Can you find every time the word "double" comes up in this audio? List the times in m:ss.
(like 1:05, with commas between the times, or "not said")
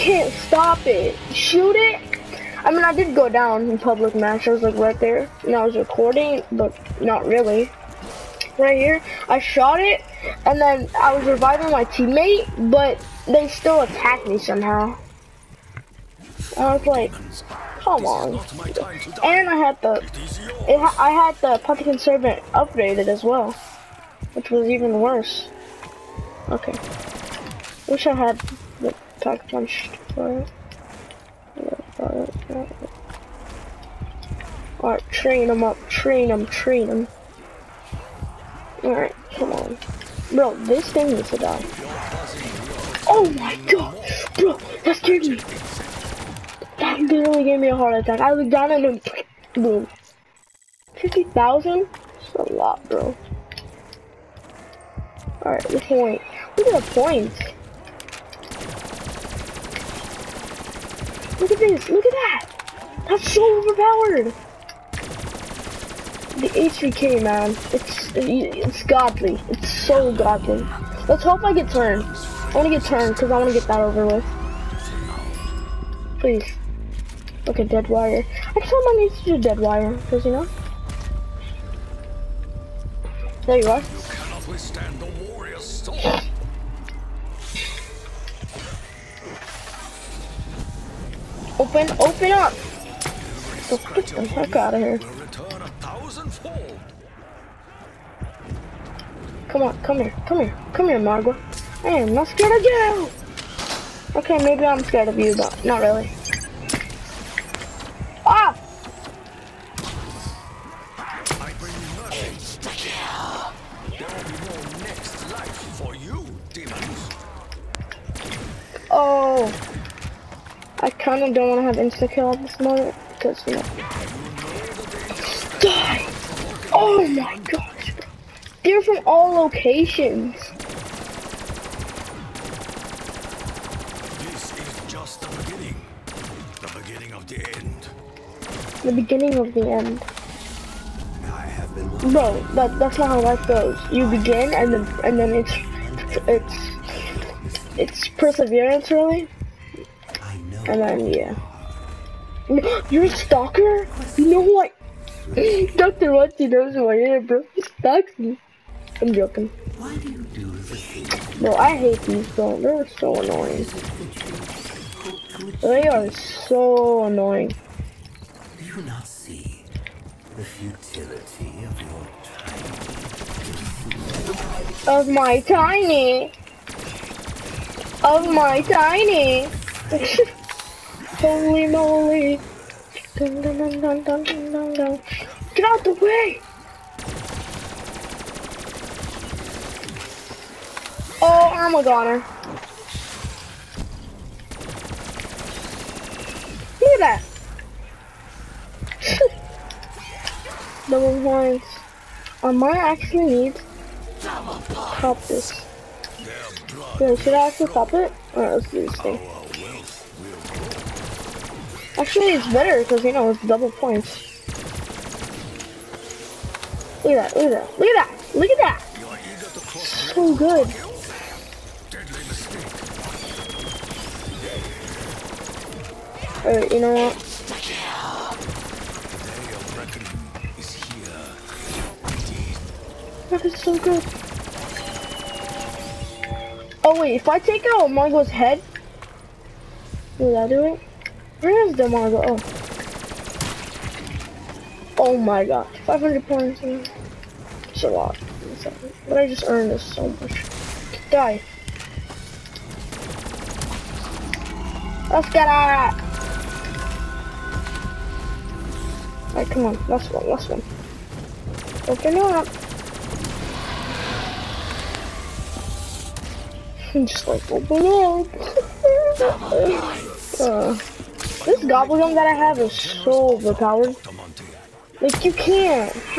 3:20, 3:33.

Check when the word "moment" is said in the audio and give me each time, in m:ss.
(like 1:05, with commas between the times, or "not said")
2:02.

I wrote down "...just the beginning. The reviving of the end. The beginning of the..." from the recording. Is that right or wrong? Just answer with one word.
wrong.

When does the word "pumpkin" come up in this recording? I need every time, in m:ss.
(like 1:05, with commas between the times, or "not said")
0:21.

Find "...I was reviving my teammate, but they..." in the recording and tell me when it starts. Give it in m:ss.
0:11.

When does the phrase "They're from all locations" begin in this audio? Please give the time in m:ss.
2:08.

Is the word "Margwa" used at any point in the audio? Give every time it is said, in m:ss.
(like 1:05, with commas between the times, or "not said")
1:40, 3:57, 4:01.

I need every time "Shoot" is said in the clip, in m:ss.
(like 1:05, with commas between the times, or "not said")
0:01.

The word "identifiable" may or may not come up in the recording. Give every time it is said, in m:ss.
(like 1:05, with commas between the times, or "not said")
not said.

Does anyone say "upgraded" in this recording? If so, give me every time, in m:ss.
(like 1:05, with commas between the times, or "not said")
0:22.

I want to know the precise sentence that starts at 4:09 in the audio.
But I just earned this so much.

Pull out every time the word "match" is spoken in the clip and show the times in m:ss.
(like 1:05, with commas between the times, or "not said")
0:04.